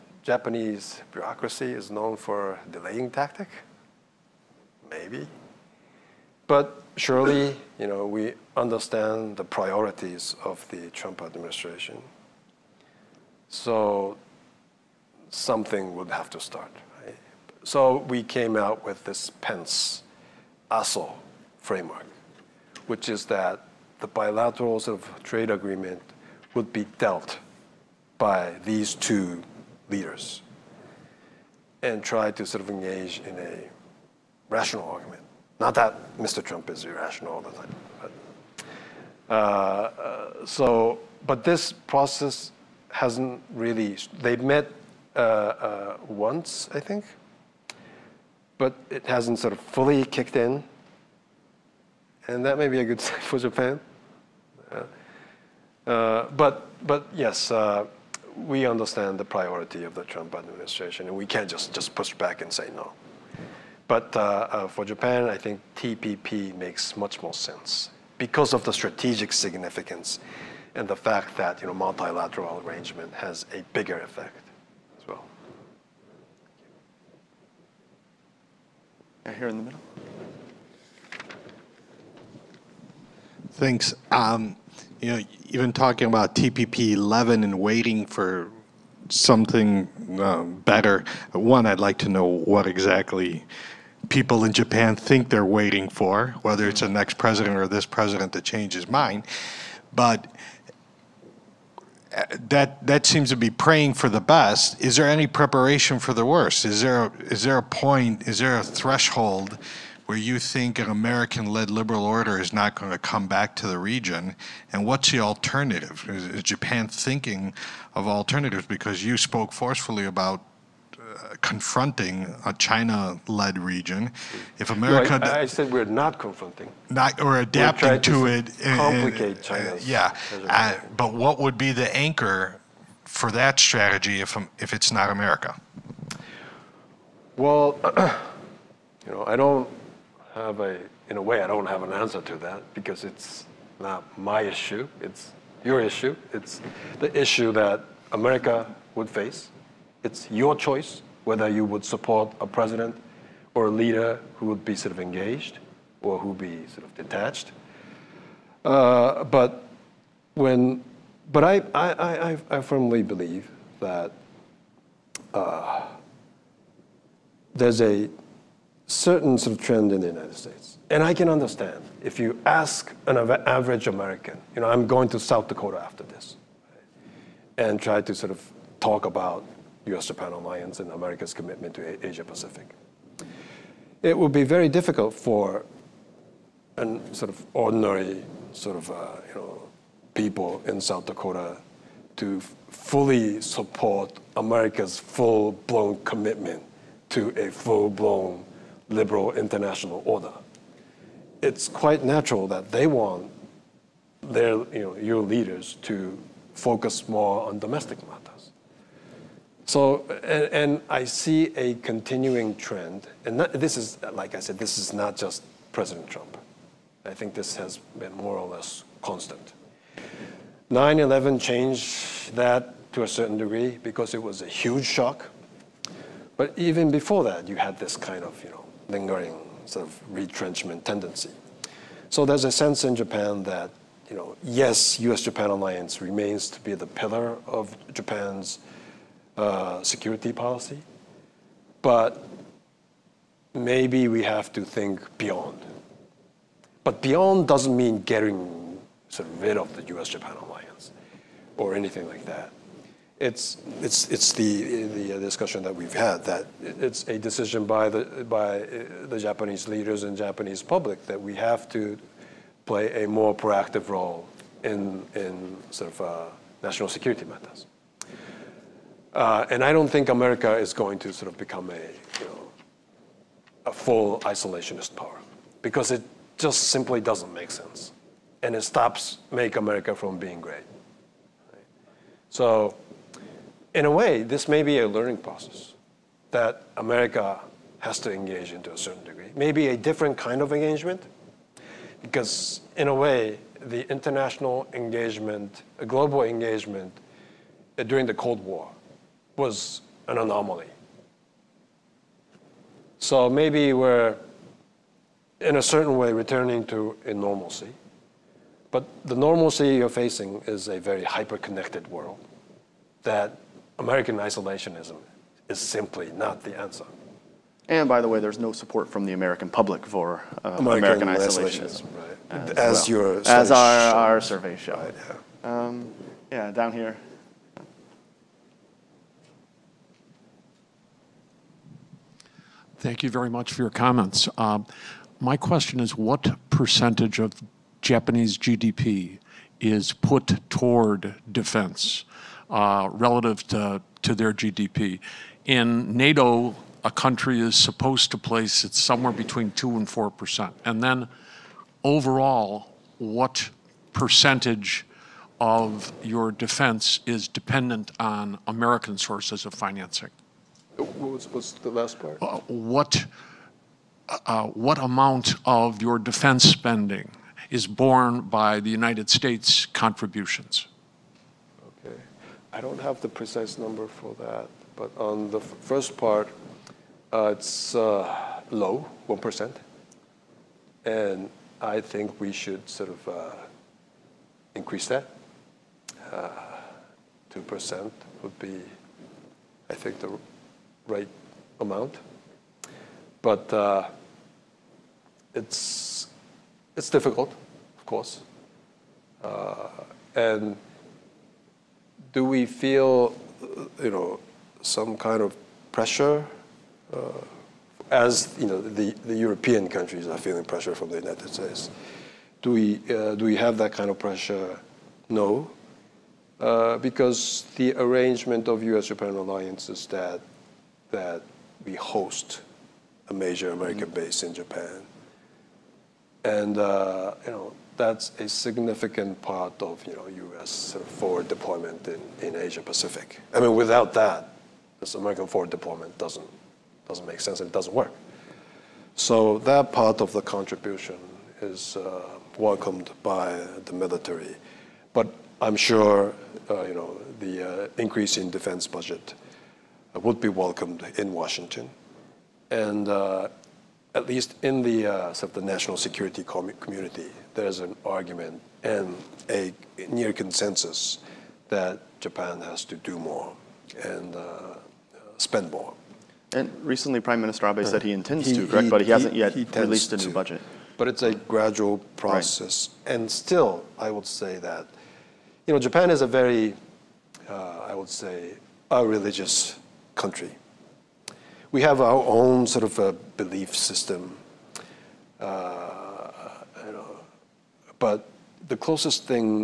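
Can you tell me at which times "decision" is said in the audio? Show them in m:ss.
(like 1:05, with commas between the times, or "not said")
4:17.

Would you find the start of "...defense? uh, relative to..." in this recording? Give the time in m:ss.
5:41.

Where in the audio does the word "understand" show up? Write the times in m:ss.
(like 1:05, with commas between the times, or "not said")
0:08, 0:58, 2:51.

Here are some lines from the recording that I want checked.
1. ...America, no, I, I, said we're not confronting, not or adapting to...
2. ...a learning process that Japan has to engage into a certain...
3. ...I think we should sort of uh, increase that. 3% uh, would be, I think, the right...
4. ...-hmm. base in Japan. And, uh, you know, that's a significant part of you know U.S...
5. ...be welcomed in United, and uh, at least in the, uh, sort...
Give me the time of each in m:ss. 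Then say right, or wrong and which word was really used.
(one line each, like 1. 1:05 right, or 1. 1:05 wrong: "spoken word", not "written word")
1. 2:04 right
2. 4:44 wrong: "America", not "Japan"
3. 6:21 wrong: "2", not "3"
4. 7:03 right
5. 7:30 wrong: "Washington", not "United".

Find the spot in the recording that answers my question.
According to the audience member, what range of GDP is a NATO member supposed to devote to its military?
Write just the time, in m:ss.
5:49.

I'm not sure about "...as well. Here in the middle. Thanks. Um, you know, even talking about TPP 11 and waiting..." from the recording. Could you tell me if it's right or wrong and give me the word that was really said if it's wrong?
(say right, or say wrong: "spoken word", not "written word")
right.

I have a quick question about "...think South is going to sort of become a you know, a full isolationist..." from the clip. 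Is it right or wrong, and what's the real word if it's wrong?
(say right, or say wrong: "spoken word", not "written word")
wrong: "America", not "South".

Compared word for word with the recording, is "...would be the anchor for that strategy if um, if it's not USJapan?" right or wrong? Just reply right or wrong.
wrong.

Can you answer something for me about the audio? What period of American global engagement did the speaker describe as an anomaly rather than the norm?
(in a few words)
the Cold War.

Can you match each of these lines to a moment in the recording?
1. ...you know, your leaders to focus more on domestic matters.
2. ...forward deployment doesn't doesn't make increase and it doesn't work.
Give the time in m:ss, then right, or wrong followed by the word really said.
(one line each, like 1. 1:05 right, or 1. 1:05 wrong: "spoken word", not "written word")
1. 3:24 right
2. 7:15 wrong: "sense", not "increase".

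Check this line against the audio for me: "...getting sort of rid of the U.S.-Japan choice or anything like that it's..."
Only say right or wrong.
wrong.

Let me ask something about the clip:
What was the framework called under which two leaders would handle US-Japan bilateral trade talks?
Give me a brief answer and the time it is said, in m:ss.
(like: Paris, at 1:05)
Pence Aso framework, at 0:19.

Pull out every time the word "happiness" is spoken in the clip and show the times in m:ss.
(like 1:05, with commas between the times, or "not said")
not said.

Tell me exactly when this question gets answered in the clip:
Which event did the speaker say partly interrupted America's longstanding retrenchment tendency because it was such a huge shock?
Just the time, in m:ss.
3:40.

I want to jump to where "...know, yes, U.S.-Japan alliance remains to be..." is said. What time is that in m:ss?
3:54.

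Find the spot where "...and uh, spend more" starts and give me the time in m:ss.
7:43.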